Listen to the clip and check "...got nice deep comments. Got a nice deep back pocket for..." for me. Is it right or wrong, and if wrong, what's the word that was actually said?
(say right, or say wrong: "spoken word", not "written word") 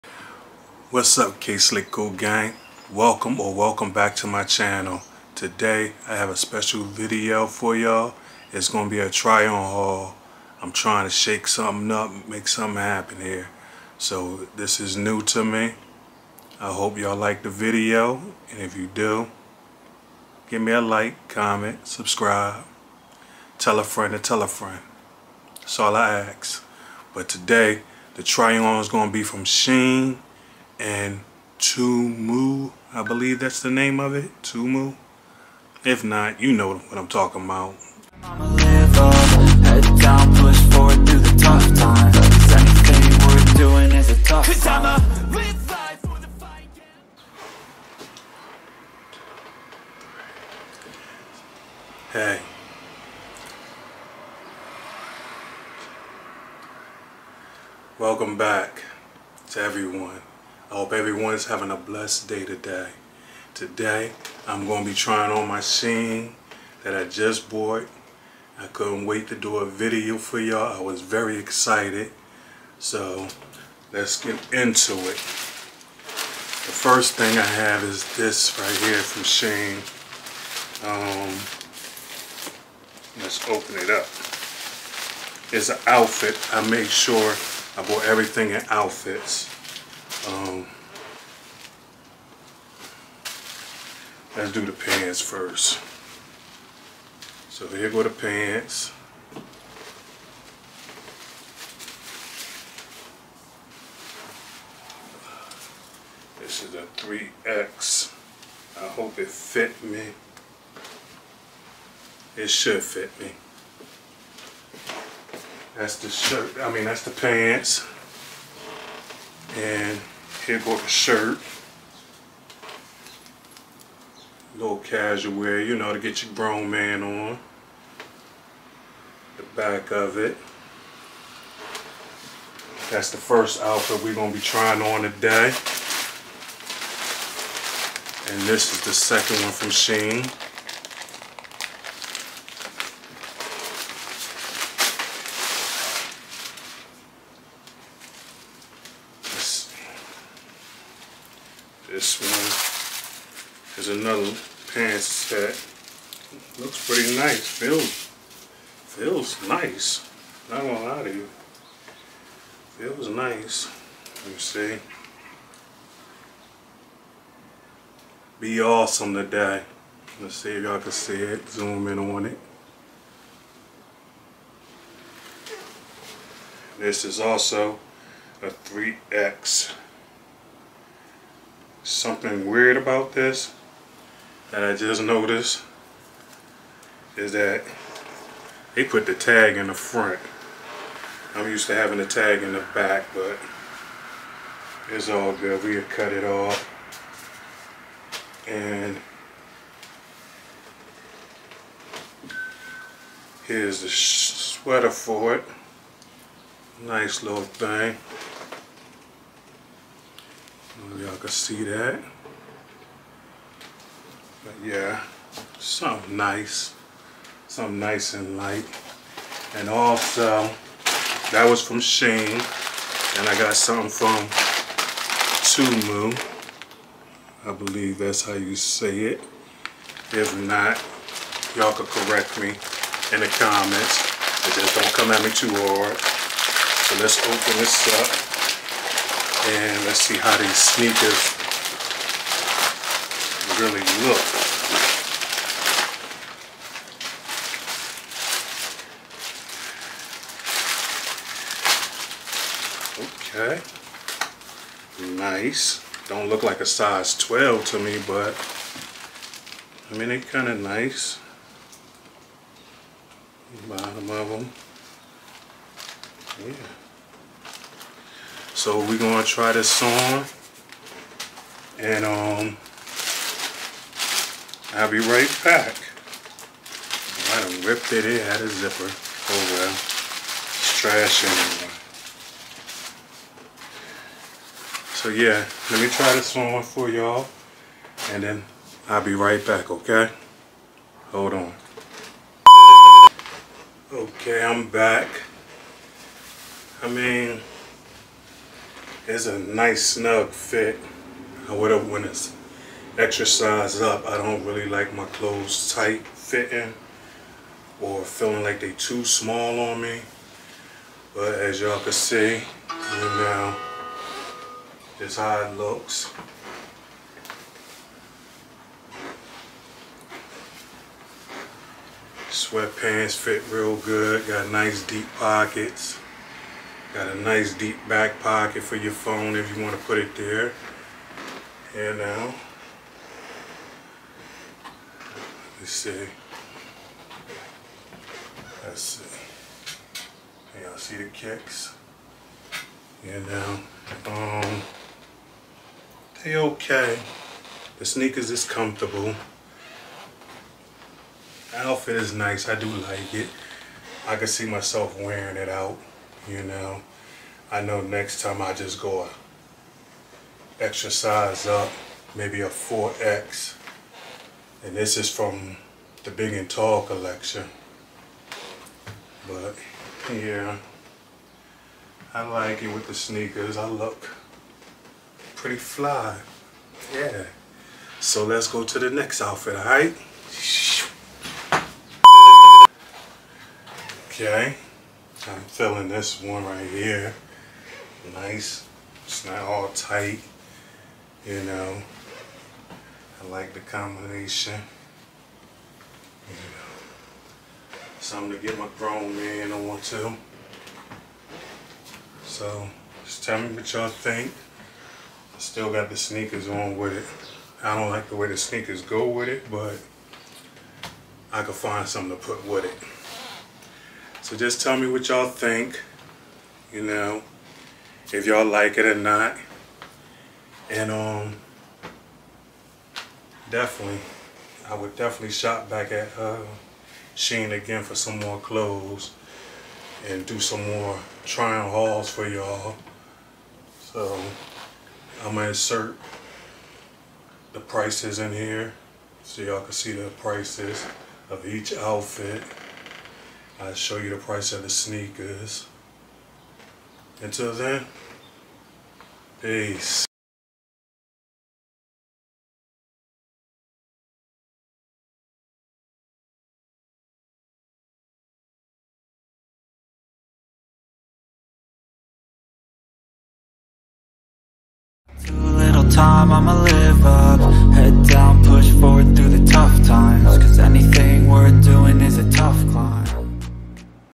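wrong: "pockets", not "comments".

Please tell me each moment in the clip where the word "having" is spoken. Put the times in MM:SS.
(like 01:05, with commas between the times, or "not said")
01:01, 03:11.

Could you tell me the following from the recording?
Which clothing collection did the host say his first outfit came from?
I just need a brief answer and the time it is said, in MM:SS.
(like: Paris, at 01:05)
Big and Tall, at 06:06.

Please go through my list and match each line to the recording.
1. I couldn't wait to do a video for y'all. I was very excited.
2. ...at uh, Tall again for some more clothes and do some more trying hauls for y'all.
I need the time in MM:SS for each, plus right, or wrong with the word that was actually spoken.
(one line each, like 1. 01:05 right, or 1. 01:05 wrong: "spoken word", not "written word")
1. 01:08 right
2. 07:05 wrong: "Shein", not "Tall".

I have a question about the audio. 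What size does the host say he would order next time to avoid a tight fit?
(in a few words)
4X.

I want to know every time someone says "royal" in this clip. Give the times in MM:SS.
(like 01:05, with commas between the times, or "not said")
not said.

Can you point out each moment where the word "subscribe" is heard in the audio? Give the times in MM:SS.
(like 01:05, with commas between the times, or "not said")
00:21.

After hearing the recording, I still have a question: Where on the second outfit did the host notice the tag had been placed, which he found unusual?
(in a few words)
the front.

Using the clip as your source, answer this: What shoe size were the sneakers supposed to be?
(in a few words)
12.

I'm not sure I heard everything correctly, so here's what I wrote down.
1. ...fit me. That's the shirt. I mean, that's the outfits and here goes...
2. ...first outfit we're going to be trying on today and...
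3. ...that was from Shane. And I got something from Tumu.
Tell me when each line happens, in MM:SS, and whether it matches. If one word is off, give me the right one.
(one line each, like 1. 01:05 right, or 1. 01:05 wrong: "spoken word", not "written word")
1. 01:52 wrong: "pants", not "outfits"
2. 02:13 right
3. 03:41 right.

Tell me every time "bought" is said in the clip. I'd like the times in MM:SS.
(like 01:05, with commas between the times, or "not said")
01:07, 01:27.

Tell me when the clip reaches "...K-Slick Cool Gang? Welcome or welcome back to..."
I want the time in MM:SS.
00:01.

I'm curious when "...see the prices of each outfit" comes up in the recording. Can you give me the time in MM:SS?
07:19.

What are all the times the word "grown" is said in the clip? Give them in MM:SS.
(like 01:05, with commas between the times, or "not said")
02:06, 06:38.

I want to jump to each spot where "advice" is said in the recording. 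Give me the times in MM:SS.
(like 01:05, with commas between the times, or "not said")
not said.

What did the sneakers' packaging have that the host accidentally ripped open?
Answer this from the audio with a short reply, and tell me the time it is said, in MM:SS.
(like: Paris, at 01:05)
a zipper, at 04:38.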